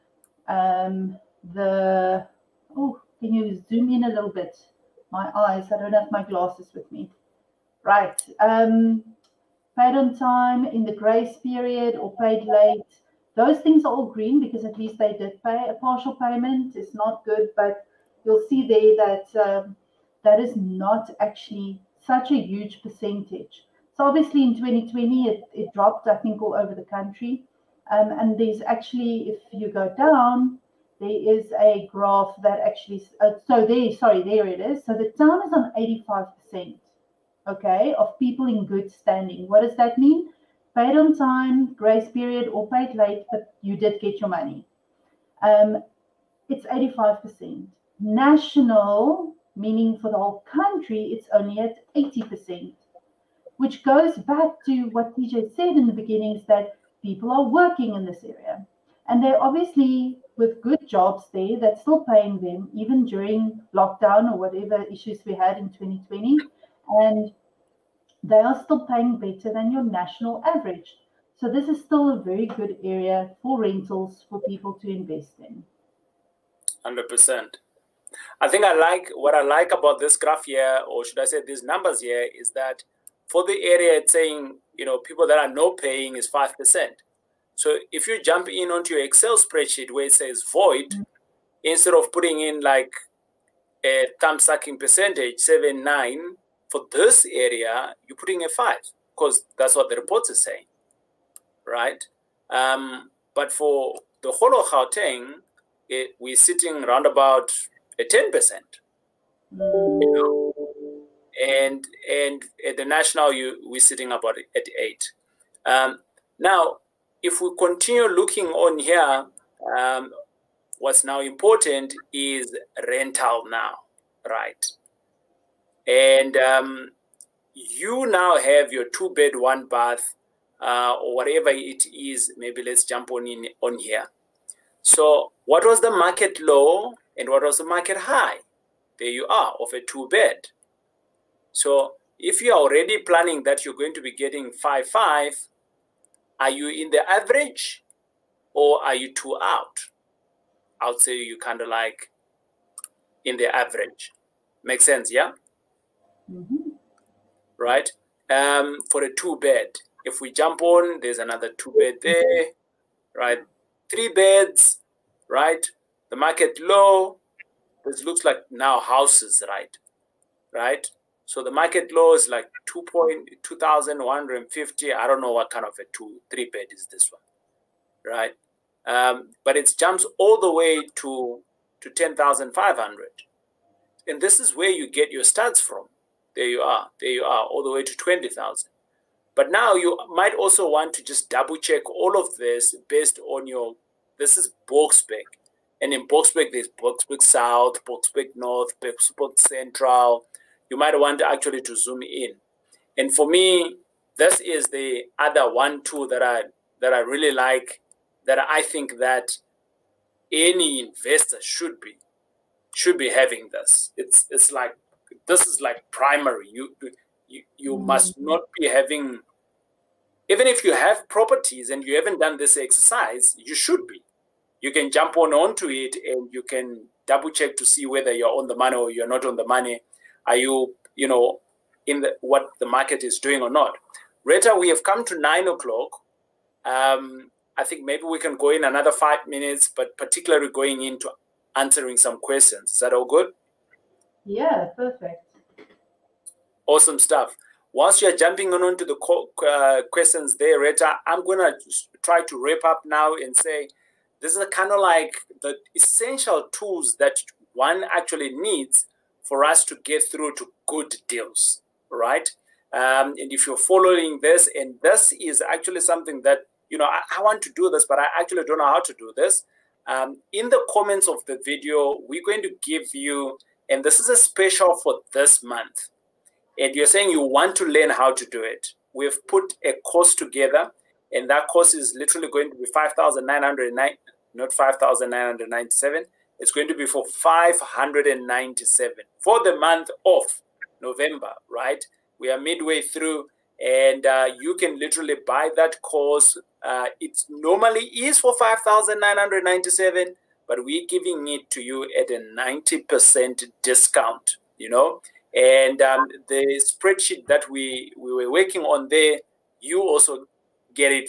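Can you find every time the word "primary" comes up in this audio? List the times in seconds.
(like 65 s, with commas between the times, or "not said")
215 s.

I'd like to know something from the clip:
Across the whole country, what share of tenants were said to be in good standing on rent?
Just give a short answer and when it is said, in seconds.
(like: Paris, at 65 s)
80%, at 51 s.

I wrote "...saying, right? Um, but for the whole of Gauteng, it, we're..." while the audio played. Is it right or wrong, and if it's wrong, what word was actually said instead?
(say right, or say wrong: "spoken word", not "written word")
right.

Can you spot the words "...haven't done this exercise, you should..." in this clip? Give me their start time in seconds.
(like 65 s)
221 s.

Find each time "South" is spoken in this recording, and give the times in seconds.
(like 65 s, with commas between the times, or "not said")
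197 s.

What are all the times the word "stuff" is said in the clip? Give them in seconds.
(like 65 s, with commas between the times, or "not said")
246 s.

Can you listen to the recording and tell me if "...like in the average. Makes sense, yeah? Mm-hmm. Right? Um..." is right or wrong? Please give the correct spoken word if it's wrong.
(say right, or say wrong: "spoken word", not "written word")
right.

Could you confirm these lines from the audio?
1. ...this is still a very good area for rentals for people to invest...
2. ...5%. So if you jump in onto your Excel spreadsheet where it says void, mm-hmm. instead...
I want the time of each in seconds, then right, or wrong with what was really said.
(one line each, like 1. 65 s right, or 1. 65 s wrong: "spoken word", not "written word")
1. 71 s right
2. 86 s right.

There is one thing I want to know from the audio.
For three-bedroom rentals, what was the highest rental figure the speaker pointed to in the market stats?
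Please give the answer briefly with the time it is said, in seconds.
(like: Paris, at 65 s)
20,000, at 187 s.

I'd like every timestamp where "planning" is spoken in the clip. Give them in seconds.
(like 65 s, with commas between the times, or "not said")
142 s.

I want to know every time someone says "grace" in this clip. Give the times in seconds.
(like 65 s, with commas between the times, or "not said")
10 s, 41 s.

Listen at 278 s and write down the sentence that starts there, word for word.
We've put a course together, and that course is literally going to be 5,909, not 5,997.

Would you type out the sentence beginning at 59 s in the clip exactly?
And they're obviously with good jobs there that's still paying them, even during lockdown or whatever issues we had in 2020.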